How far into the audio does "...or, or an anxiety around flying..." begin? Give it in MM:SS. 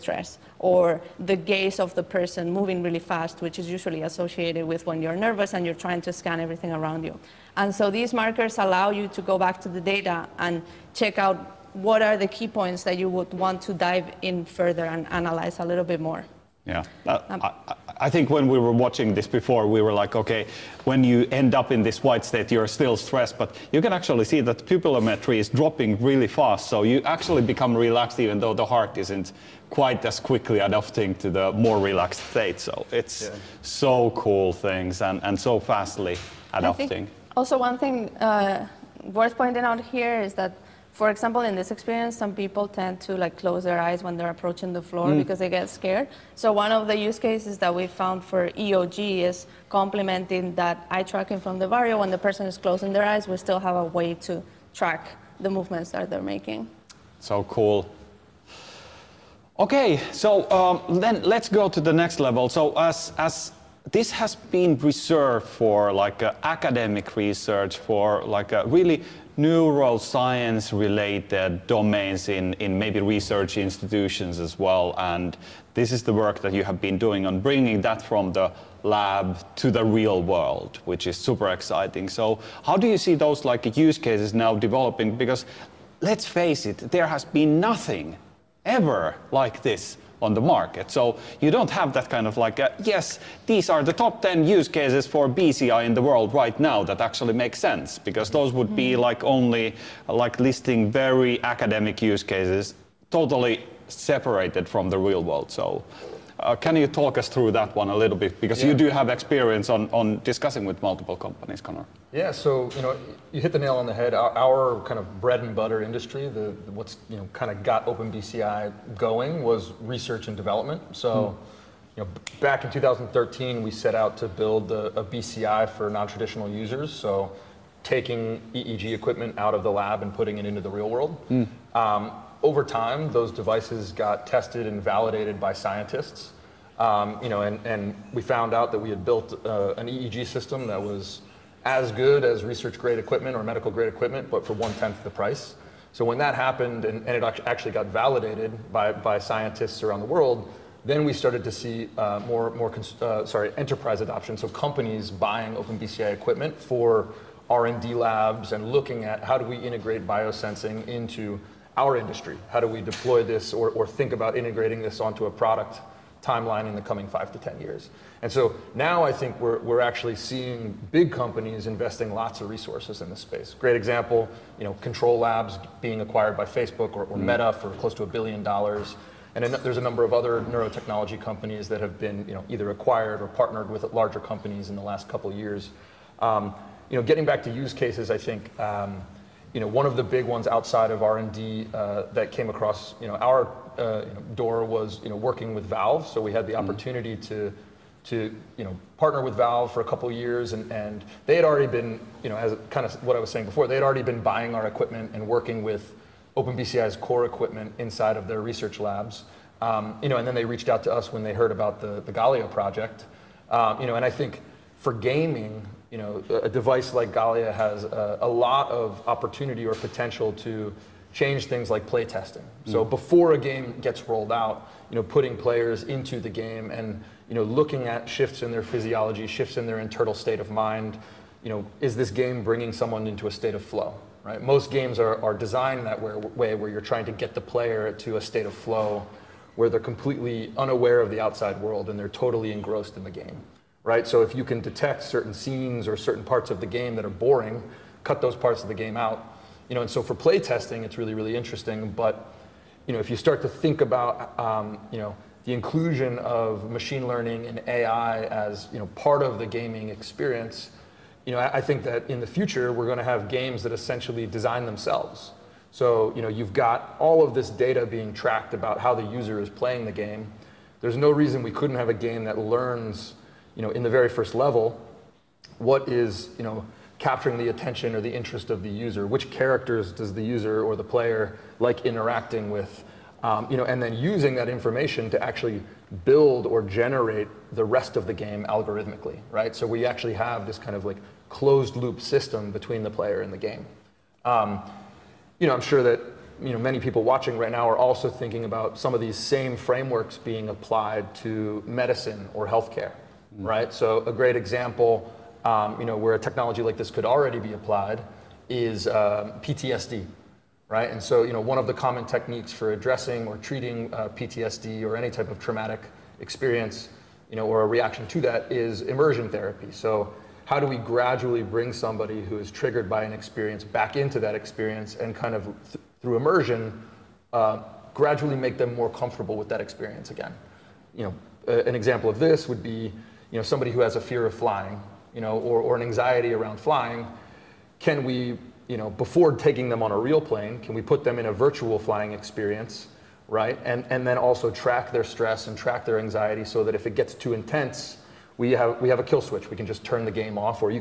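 05:35.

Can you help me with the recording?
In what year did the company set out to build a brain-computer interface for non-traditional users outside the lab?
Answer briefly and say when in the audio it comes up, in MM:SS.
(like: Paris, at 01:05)
2013, at 02:02.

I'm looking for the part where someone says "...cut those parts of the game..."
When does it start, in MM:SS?
04:08.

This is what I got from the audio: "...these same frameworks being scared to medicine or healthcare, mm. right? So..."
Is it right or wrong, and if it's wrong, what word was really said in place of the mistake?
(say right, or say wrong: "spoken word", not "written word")
wrong: "applied", not "scared".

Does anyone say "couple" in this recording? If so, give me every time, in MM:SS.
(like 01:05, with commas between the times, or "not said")
03:05, 03:19.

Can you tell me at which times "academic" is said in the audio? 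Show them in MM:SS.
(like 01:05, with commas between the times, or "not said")
01:06, 01:41.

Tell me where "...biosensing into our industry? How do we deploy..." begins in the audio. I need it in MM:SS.
02:40.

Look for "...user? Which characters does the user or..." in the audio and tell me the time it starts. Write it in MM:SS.
04:38.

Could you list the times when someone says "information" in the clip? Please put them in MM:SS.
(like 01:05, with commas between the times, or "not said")
04:44.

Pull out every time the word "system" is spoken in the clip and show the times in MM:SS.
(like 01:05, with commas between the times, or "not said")
02:20, 04:51.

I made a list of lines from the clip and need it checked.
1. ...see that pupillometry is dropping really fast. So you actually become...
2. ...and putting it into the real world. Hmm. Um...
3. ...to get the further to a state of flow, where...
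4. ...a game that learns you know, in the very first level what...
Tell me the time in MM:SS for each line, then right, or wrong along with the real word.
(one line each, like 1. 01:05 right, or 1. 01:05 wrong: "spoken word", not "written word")
1. 00:24 right
2. 02:10 right
3. 03:57 wrong: "player", not "further"
4. 04:31 right.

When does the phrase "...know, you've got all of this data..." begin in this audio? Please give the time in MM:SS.
04:26.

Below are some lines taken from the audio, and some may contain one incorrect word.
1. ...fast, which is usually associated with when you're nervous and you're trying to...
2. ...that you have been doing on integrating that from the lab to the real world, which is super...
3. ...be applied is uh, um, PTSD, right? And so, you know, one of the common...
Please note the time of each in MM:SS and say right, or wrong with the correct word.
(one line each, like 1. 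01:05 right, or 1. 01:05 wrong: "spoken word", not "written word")
1. 00:02 right
2. 01:16 wrong: "bringing", not "integrating"
3. 05:07 right.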